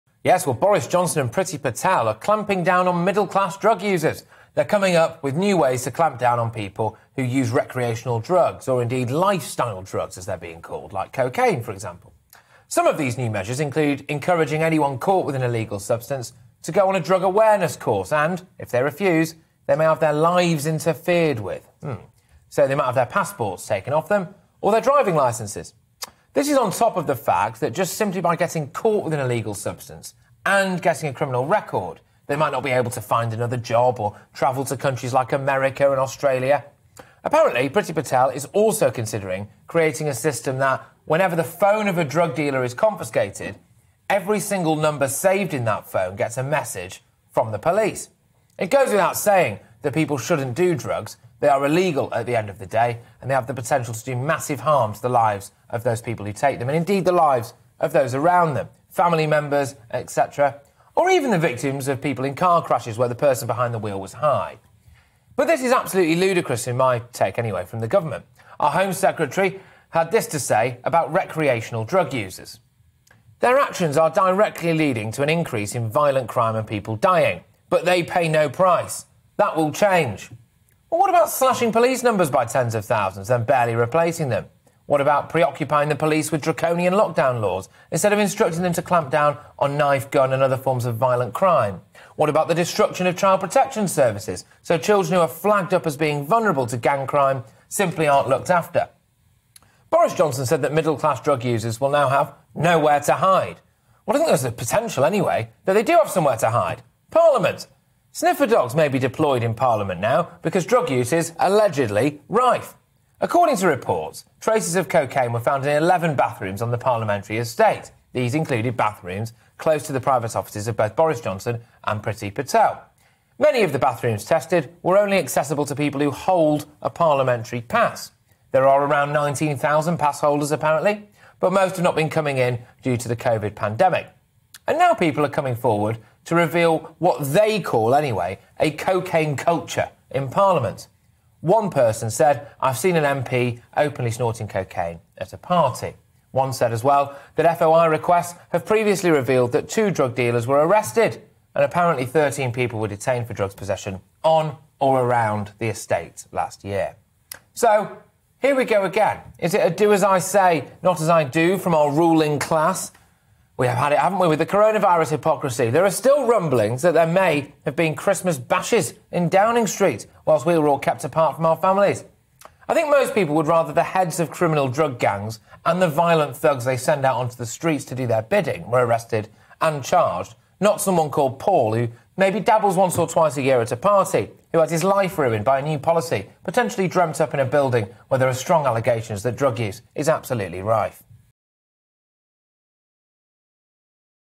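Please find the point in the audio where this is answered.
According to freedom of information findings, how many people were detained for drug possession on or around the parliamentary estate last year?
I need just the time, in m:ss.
2:32.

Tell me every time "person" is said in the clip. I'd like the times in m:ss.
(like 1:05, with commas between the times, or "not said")
1:03, 2:21.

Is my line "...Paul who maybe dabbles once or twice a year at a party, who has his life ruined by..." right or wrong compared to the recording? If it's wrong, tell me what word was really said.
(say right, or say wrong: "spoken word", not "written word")
right.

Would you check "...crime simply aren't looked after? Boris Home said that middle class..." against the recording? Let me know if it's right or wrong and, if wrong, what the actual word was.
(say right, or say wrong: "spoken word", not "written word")
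wrong: "Johnson", not "Home".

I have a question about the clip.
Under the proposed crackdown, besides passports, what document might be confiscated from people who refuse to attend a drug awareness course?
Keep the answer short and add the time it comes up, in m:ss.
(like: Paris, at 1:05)
driving licenses, at 0:24.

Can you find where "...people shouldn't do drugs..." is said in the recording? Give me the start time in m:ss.
0:49.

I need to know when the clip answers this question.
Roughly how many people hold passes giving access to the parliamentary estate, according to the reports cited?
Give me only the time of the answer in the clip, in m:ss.
2:09.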